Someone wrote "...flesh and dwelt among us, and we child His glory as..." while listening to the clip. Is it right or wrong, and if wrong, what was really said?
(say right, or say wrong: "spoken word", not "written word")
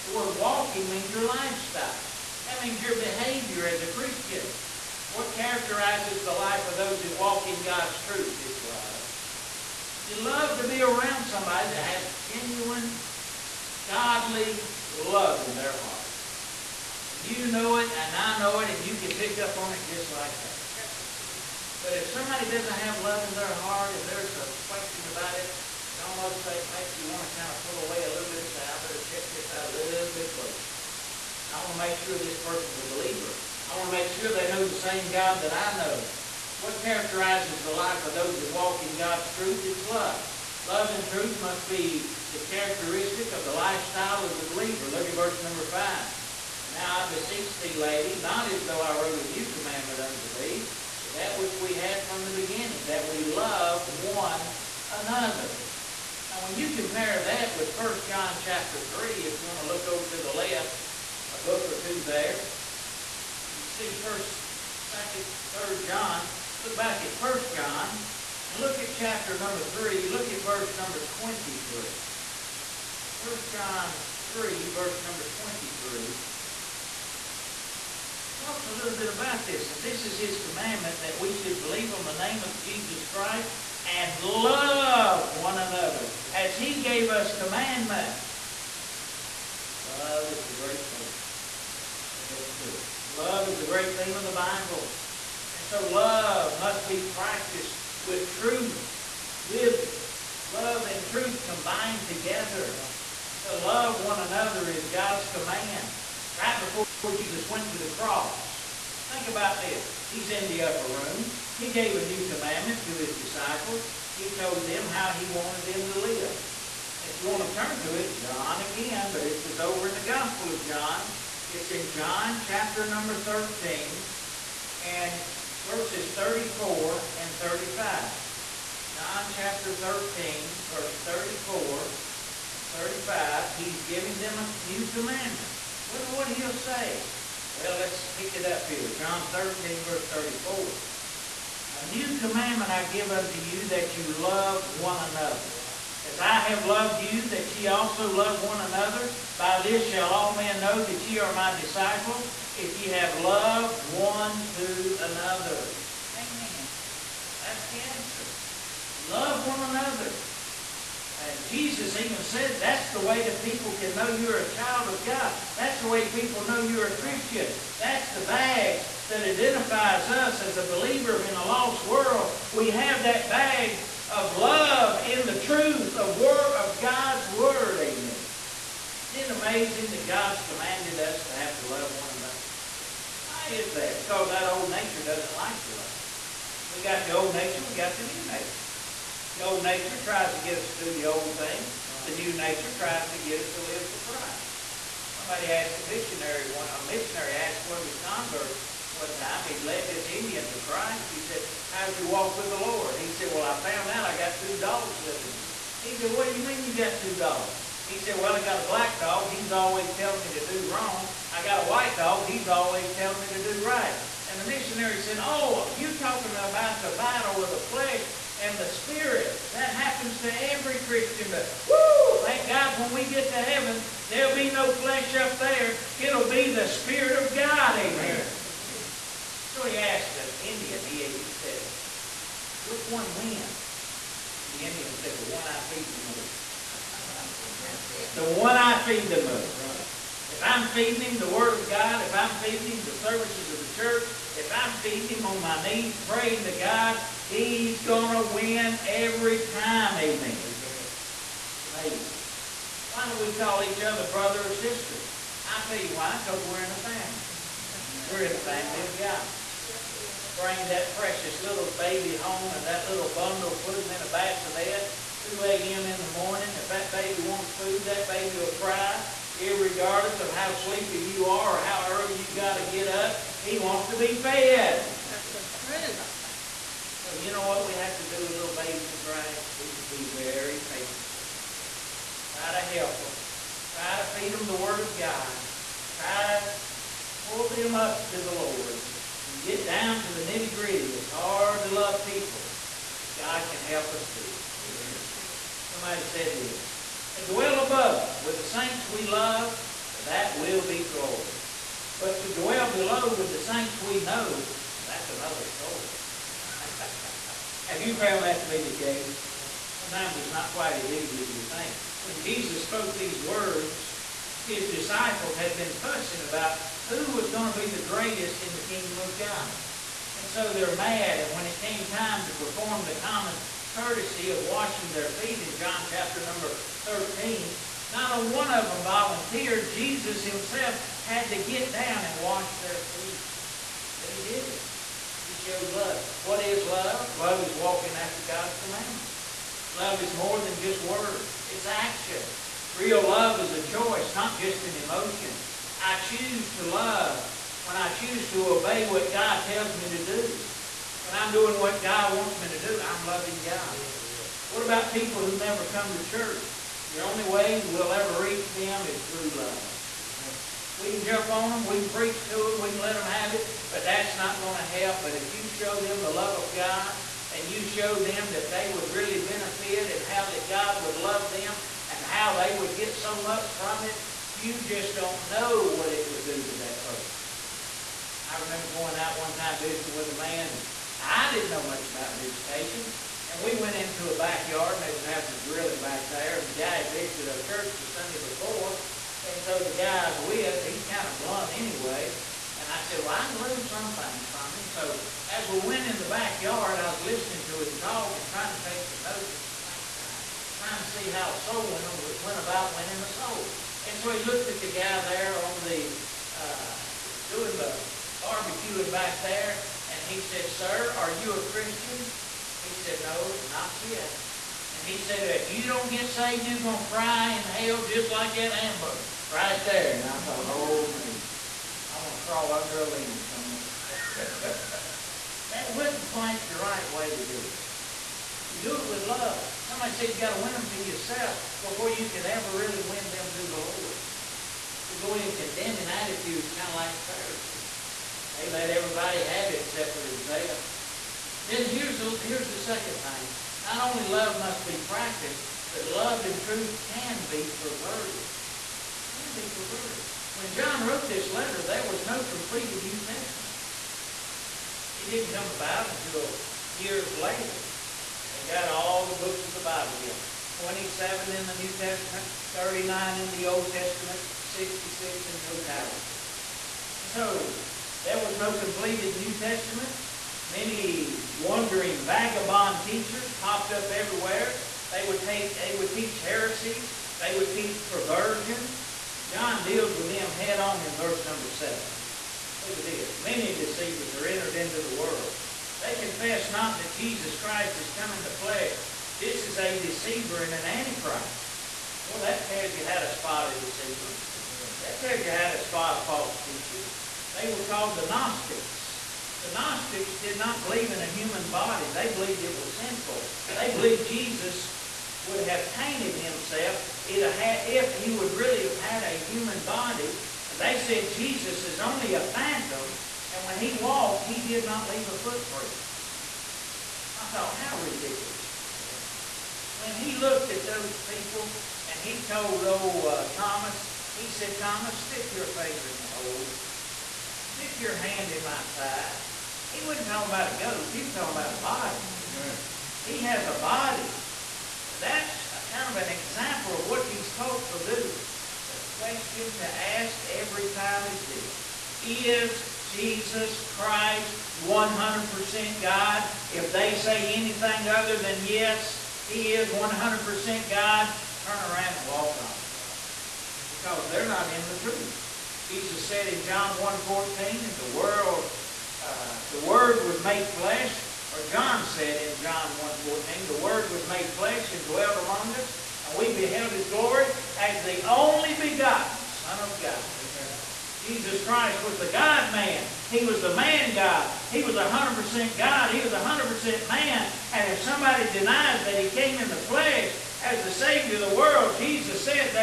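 wrong: "beheld", not "child".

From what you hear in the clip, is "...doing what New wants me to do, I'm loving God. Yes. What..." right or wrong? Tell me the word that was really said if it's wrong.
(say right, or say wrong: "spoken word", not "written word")
wrong: "God", not "New".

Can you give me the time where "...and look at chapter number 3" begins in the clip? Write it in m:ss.
1:08.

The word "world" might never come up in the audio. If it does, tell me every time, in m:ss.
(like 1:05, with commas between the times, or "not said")
2:51, 8:04, 9:17, 9:41.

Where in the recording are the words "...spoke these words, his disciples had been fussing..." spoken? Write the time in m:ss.
5:12.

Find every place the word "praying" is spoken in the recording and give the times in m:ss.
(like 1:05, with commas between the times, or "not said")
4:06.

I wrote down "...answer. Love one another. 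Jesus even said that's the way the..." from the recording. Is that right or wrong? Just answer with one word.
right.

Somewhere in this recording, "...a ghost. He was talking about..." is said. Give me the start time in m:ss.
8:50.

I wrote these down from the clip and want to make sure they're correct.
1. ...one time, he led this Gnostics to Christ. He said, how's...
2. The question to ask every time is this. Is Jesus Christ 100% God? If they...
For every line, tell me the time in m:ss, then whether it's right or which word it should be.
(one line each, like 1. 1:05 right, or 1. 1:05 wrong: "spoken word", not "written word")
1. 3:18 wrong: "Indian", not "Gnostics"
2. 8:58 right.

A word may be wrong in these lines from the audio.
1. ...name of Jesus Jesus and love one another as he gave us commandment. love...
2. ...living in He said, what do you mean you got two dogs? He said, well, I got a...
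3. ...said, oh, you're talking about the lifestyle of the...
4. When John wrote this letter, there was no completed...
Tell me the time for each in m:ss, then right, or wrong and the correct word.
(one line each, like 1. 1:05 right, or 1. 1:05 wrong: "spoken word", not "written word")
1. 1:22 wrong: "Christ", not "Jesus"
2. 3:25 right
3. 3:34 wrong: "battle", not "lifestyle"
4. 7:30 right.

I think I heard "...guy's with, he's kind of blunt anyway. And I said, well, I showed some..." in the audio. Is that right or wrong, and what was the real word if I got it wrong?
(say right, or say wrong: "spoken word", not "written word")
wrong: "learned", not "showed".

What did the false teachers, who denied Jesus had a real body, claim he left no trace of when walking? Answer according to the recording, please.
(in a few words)
A footprint.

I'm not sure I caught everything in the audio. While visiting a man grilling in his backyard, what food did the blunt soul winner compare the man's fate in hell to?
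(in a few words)
Hamburger.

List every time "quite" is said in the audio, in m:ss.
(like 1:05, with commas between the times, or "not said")
5:10, 7:06.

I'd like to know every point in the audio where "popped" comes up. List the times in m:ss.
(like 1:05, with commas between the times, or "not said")
7:53.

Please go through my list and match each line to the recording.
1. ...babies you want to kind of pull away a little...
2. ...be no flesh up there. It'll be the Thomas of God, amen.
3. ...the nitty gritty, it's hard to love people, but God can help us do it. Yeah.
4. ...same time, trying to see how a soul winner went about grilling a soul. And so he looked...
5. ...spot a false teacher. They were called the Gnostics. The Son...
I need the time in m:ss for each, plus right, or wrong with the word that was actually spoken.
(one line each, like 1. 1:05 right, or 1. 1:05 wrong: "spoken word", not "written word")
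1. 0:26 wrong: "makes", not "babies"
2. 3:44 wrong: "Spirit", not "Thomas"
3. 4:50 right
4. 6:39 wrong: "winning", not "grilling"
5. 8:15 wrong: "Gnostics", not "Son".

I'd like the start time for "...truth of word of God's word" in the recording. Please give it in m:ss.
2:55.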